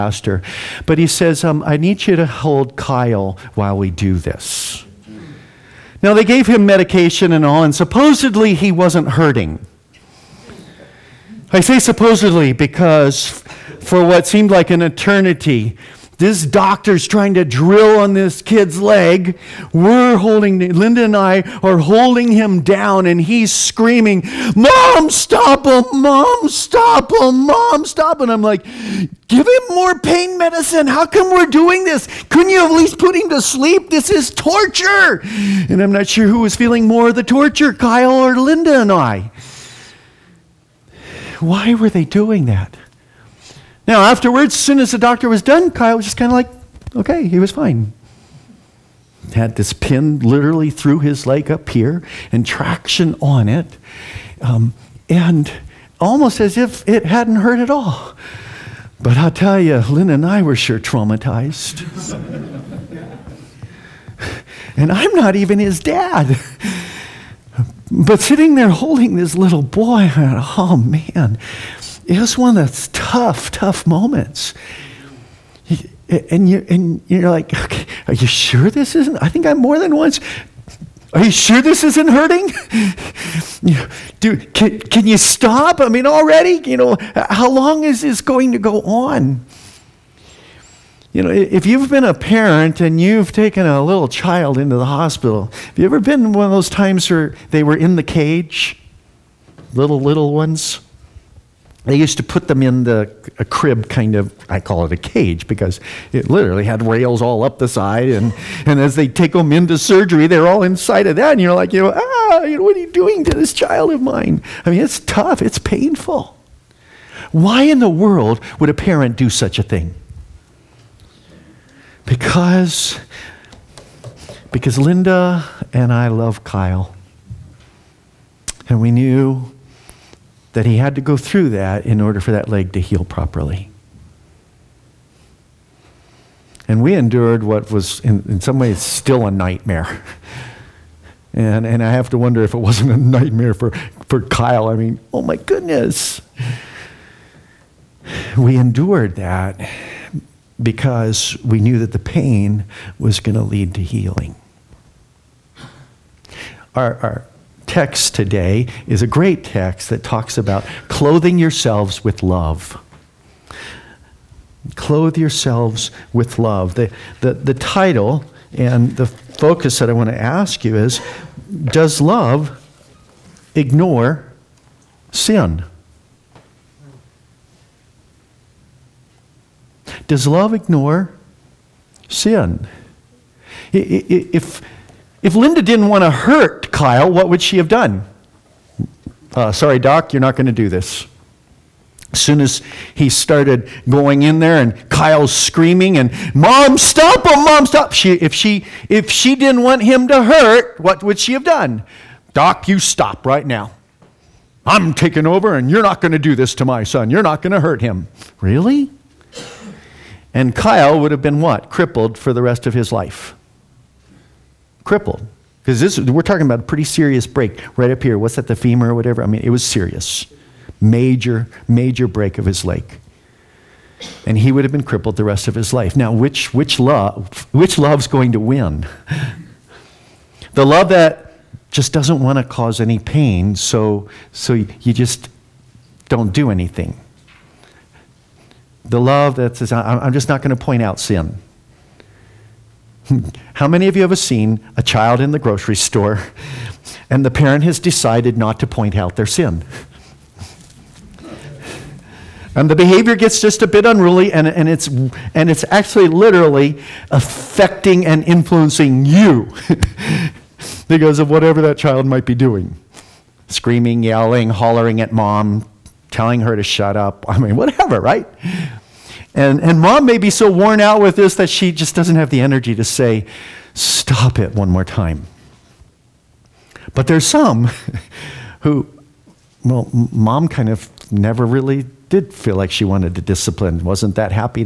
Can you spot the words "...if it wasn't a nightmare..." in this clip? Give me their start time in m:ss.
2:22.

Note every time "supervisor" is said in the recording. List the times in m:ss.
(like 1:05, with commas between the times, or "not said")
not said.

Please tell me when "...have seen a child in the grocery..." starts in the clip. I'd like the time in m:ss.
4:04.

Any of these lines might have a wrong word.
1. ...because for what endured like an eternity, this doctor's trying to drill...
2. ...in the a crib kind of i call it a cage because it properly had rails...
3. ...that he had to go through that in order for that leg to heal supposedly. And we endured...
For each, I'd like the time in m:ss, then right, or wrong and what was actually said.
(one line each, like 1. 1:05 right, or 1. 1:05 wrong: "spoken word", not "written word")
1. 0:12 wrong: "seemed", not "endured"
2. 1:42 wrong: "literally", not "properly"
3. 2:10 wrong: "properly", not "supposedly".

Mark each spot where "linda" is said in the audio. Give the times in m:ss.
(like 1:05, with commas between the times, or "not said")
0:20, 0:38, 2:04, 3:05.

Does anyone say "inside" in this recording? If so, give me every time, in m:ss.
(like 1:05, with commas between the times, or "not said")
1:50.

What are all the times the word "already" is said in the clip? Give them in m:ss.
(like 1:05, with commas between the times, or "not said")
1:26.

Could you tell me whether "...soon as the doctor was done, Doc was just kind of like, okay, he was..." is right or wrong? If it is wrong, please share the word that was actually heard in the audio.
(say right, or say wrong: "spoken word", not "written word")
wrong: "Kyle", not "Doc".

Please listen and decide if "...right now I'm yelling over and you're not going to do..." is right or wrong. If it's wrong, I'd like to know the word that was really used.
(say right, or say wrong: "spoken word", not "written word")
wrong: "taking", not "yelling".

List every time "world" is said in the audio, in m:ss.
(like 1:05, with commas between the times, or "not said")
1:57.